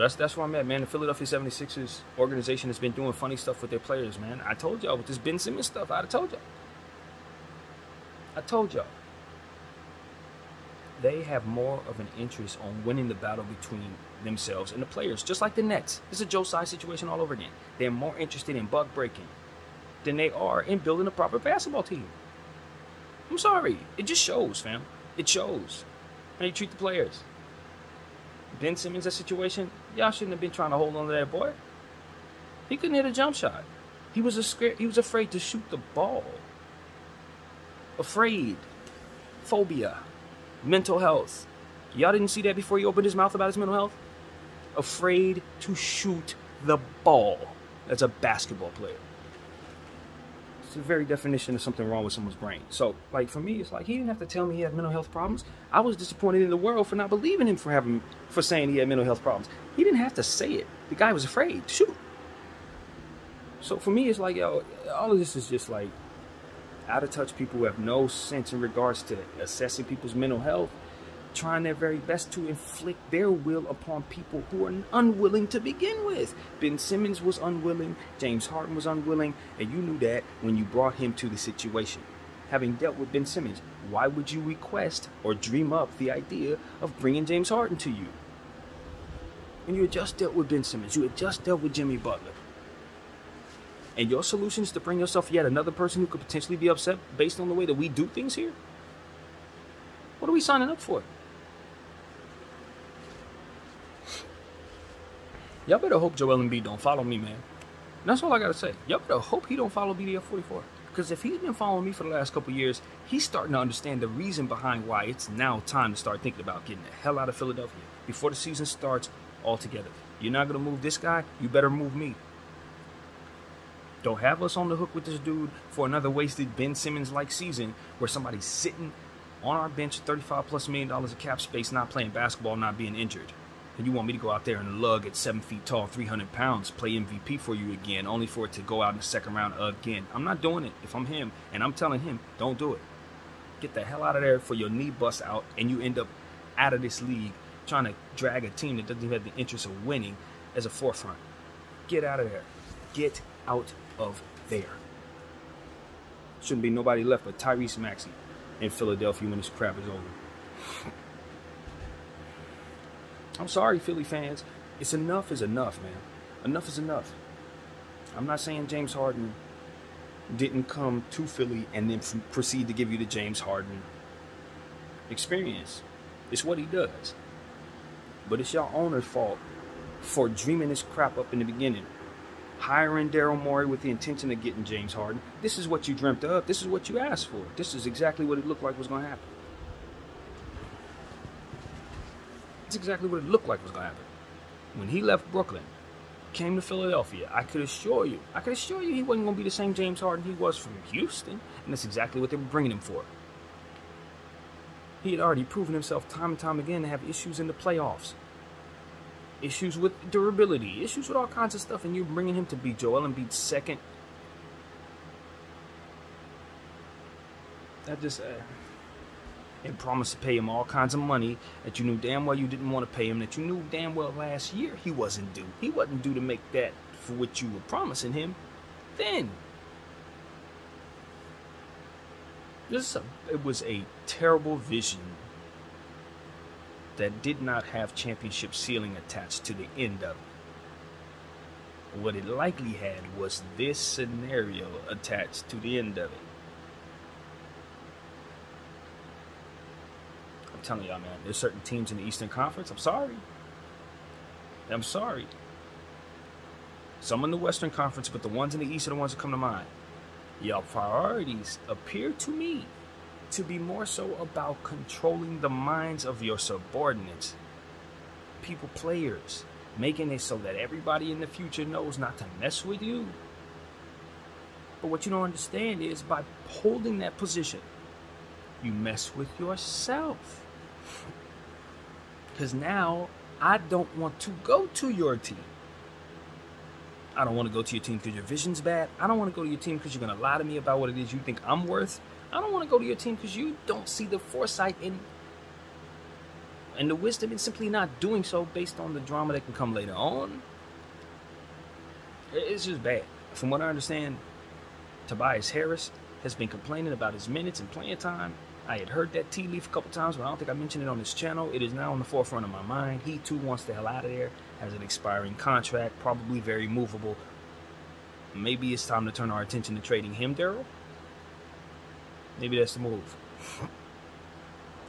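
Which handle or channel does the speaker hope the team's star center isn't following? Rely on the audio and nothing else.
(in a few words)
BDF 44.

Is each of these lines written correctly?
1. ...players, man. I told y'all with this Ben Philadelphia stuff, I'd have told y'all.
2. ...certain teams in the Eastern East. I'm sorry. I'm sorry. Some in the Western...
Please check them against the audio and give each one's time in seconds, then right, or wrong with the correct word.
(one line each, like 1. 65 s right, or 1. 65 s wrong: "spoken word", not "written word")
1. 3 s wrong: "Simmons", not "Philadelphia"
2. 251 s wrong: "Conference", not "East".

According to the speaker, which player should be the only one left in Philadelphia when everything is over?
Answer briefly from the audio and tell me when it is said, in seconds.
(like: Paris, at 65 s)
Tyrese Maxey, at 157 s.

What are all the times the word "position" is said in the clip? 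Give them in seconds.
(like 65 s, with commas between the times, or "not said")
277 s.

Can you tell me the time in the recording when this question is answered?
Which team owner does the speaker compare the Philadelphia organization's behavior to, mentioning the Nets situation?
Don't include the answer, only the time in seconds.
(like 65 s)
16 s.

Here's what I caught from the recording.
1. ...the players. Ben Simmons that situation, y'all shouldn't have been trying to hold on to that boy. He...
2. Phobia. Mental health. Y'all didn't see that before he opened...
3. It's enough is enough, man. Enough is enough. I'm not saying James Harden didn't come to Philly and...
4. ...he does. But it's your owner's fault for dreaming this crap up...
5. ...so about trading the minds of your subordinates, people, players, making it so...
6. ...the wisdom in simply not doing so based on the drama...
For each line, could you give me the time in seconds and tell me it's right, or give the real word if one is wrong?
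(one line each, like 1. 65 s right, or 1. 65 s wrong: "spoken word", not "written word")
1. 26 s right
2. 39 s right
3. 164 s right
4. 176 s right
5. 263 s wrong: "controlling", not "trading"
6. 296 s right.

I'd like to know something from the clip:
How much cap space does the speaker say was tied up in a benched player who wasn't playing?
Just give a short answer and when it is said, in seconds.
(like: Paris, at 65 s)
35 plus million, at 129 s.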